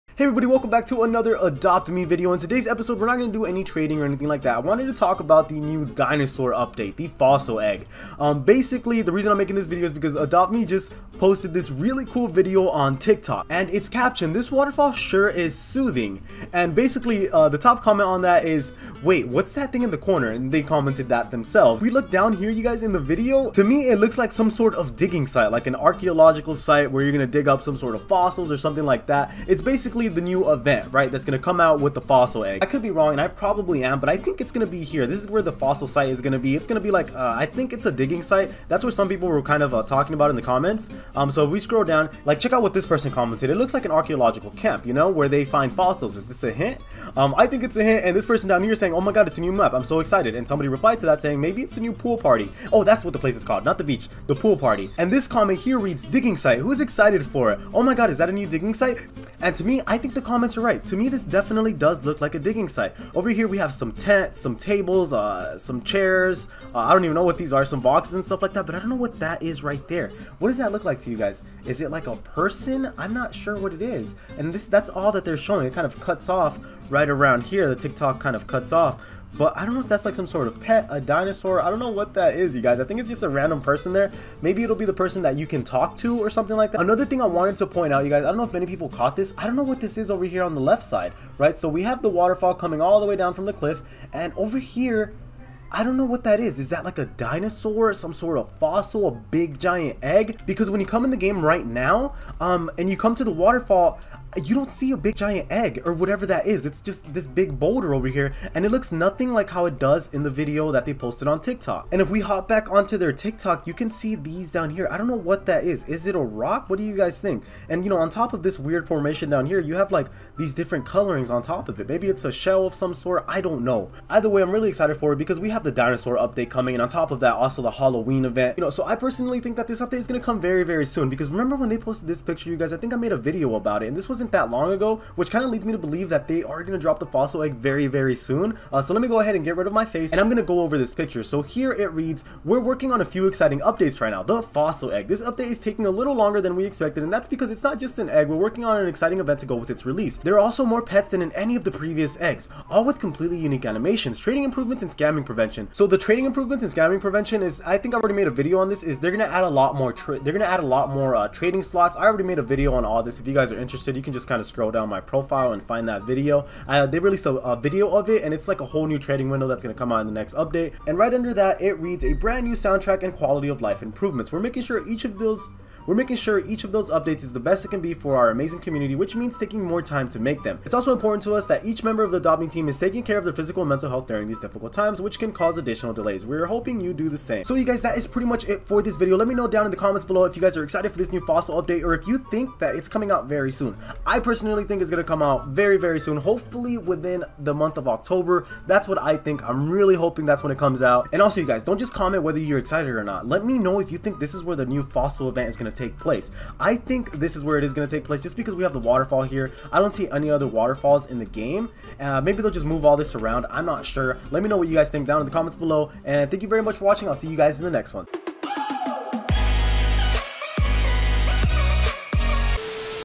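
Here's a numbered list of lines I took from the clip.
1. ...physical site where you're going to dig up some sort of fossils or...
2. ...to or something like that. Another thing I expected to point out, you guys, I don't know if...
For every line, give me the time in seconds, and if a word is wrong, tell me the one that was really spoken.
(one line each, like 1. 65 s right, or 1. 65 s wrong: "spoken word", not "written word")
1. 25 s wrong: "archaeological", not "physical"
2. 85 s wrong: "wanted", not "expected".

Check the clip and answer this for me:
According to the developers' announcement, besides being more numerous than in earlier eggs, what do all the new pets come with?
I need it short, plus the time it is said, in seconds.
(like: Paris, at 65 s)
completely unique animations, at 152 s.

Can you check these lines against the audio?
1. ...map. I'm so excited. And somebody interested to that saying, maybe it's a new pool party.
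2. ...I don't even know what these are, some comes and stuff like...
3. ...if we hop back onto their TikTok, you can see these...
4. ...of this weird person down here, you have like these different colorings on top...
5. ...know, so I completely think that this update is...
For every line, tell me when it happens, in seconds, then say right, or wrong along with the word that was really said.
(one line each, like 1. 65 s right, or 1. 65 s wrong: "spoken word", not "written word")
1. 49 s wrong: "replied", not "interested"
2. 66 s wrong: "boxes", not "comes"
3. 112 s right
4. 118 s wrong: "formation", not "person"
5. 128 s wrong: "personally", not "completely".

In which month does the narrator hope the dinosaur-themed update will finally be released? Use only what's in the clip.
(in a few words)
October.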